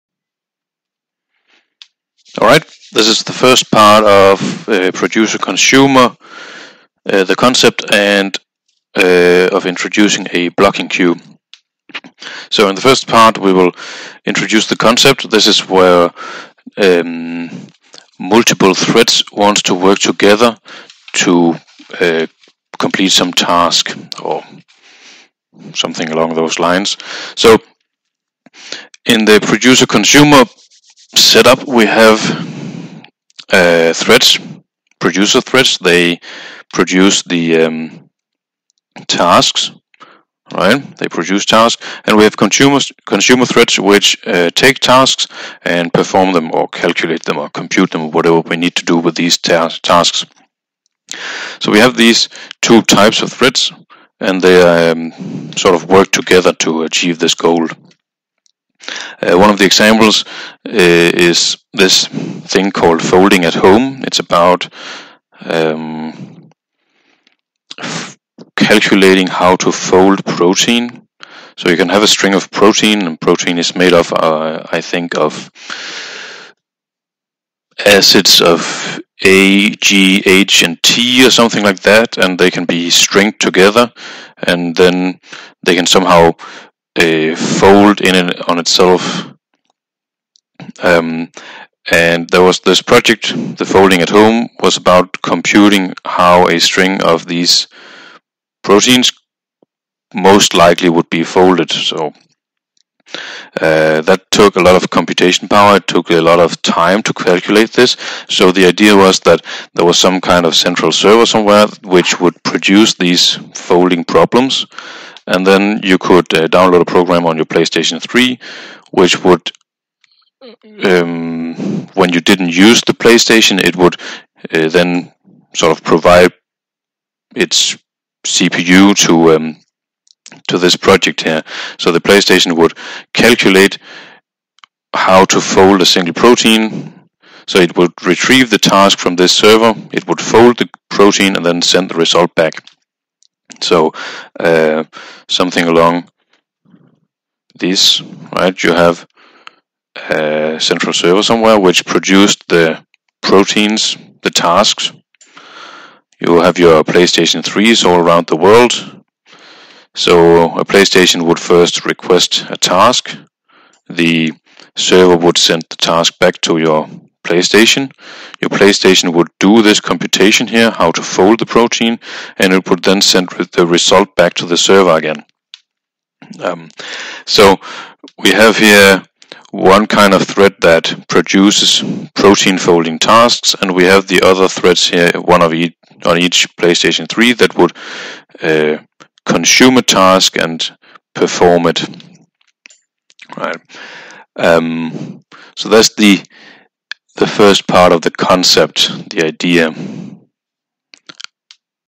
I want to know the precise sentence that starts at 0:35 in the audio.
They produce the um, tasks, right?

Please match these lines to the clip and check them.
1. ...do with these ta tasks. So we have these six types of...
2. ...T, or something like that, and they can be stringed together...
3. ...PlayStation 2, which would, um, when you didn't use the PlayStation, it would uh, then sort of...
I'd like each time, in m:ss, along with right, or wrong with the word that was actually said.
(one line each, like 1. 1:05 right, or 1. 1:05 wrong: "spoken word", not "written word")
1. 0:48 wrong: "two", not "six"
2. 1:20 right
3. 1:57 wrong: "3", not "2".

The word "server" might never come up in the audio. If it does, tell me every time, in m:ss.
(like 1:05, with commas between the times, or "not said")
1:50, 2:19, 2:30, 2:44, 2:54.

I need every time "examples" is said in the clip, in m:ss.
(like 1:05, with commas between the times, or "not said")
0:59.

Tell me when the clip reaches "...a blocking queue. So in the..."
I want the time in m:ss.
0:10.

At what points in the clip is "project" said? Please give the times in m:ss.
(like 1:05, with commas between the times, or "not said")
1:32, 2:10.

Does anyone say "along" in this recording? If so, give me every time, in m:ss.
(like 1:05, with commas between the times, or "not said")
0:26, 2:25.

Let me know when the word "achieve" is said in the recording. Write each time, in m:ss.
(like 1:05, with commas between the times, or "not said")
0:56.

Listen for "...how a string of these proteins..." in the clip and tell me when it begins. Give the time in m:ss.
1:36.